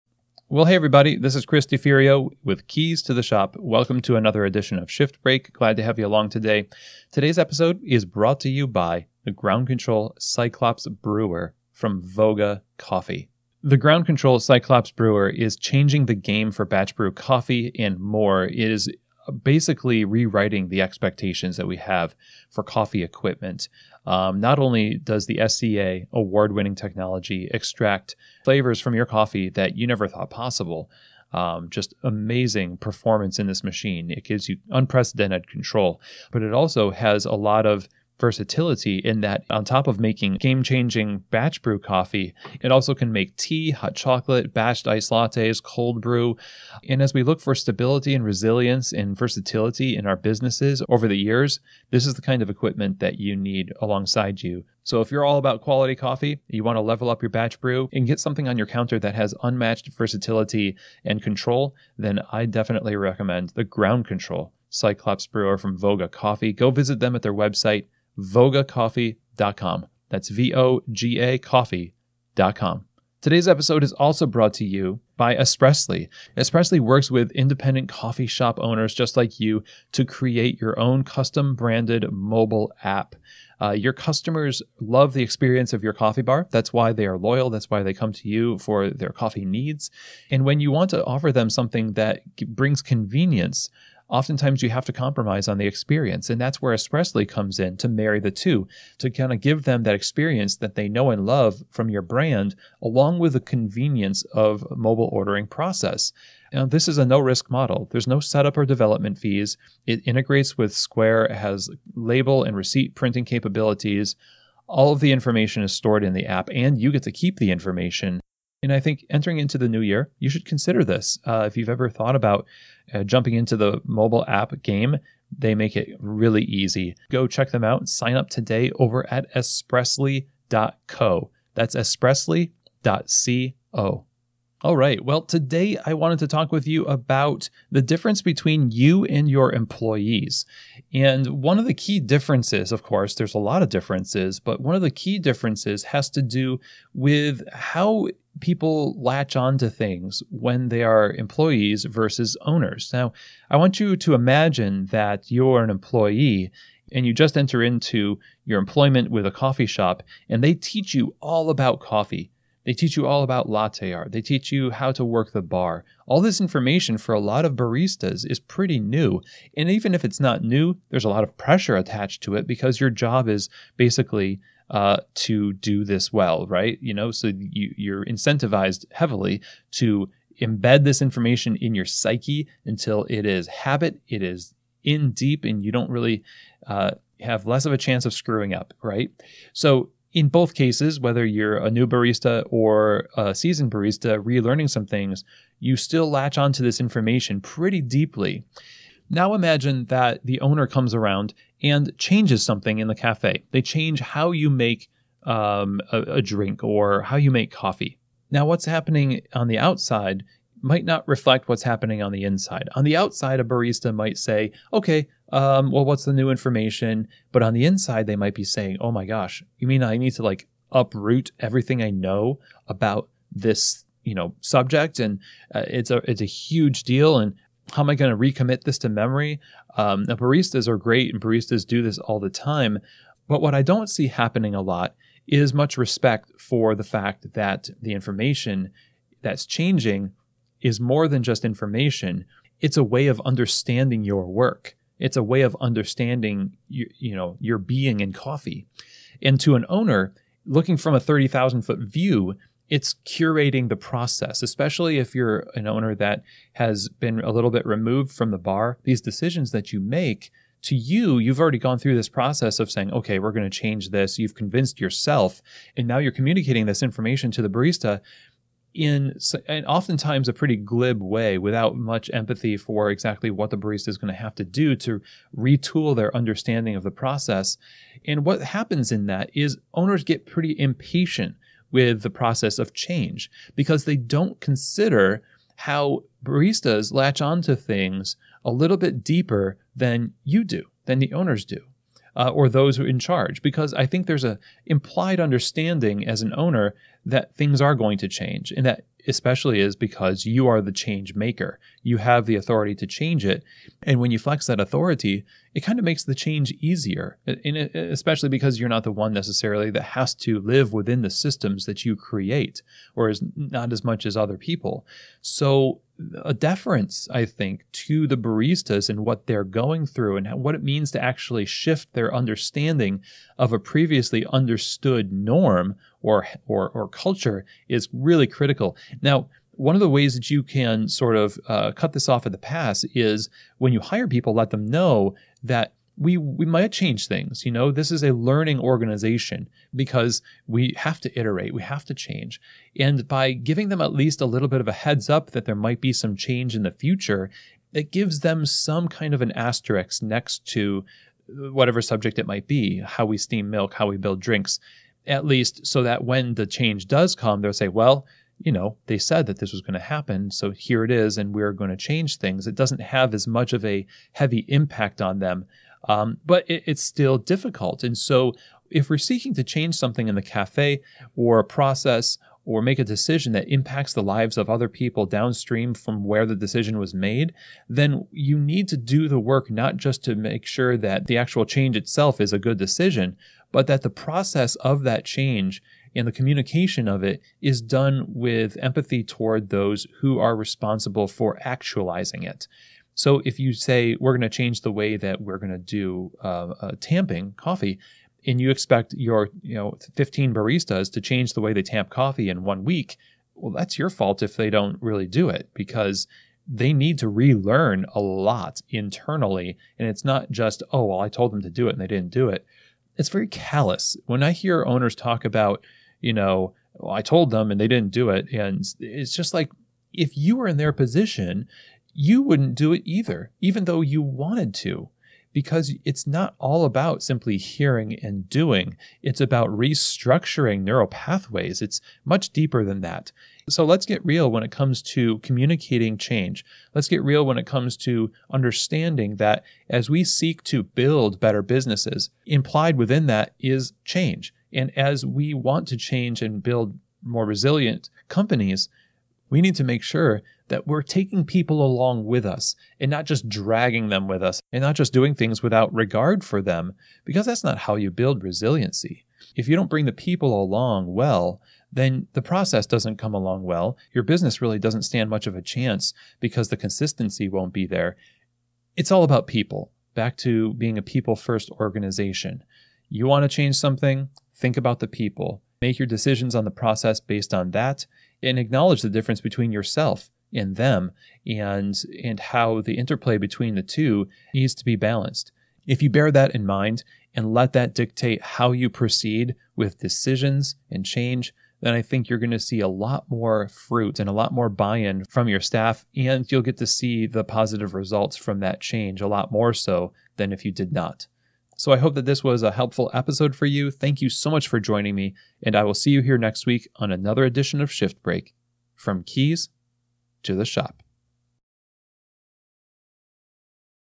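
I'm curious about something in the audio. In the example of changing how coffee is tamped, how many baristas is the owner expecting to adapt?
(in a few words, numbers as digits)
15.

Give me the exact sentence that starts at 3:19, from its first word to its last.
Now imagine that the owner comes around and changes something in the cafe.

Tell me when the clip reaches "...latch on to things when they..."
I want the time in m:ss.
2:29.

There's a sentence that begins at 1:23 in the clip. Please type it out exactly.
Uh, your customers love the experience of your coffee bar.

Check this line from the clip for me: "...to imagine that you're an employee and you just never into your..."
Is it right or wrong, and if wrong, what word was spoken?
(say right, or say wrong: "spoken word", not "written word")
wrong: "enter", not "never".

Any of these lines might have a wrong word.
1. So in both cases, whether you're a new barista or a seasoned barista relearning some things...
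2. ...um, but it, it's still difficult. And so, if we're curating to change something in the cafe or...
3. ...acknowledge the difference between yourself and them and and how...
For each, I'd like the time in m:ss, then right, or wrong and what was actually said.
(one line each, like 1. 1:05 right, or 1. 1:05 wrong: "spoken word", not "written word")
1. 3:09 right
2. 6:05 wrong: "seeking", not "curating"
3. 7:58 right.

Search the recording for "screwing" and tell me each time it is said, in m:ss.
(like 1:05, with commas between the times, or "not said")
3:08.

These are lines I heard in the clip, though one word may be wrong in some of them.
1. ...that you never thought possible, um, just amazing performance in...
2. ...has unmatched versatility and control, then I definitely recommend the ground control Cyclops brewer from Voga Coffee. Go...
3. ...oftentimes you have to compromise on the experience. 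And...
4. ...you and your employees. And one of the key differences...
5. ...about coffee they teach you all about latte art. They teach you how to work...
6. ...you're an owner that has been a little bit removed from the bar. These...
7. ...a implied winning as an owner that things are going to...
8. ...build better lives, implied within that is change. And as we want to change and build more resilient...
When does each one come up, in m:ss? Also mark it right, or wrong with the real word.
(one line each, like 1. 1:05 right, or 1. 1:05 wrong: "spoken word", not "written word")
1. 0:29 right
2. 0:59 right
3. 1:34 right
4. 2:18 right
5. 2:41 right
6. 4:15 right
7. 4:54 wrong: "understanding", not "winning"
8. 7:20 wrong: "businesses", not "lives".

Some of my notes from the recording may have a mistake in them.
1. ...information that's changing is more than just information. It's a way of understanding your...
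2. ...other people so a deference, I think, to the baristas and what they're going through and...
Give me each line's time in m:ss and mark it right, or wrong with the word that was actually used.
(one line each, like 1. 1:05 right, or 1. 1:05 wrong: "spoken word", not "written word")
1. 3:57 right
2. 5:14 right.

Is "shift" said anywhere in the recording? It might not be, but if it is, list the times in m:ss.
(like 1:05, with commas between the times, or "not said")
0:04, 5:21, 8:27.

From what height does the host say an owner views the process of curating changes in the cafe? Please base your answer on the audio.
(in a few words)
30,000 foot view.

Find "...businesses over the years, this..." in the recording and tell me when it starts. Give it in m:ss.
0:50.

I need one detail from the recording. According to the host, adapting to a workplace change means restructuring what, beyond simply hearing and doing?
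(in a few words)
neural pathways.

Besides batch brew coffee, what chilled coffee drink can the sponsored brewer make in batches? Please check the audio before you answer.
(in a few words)
batched iced lattes.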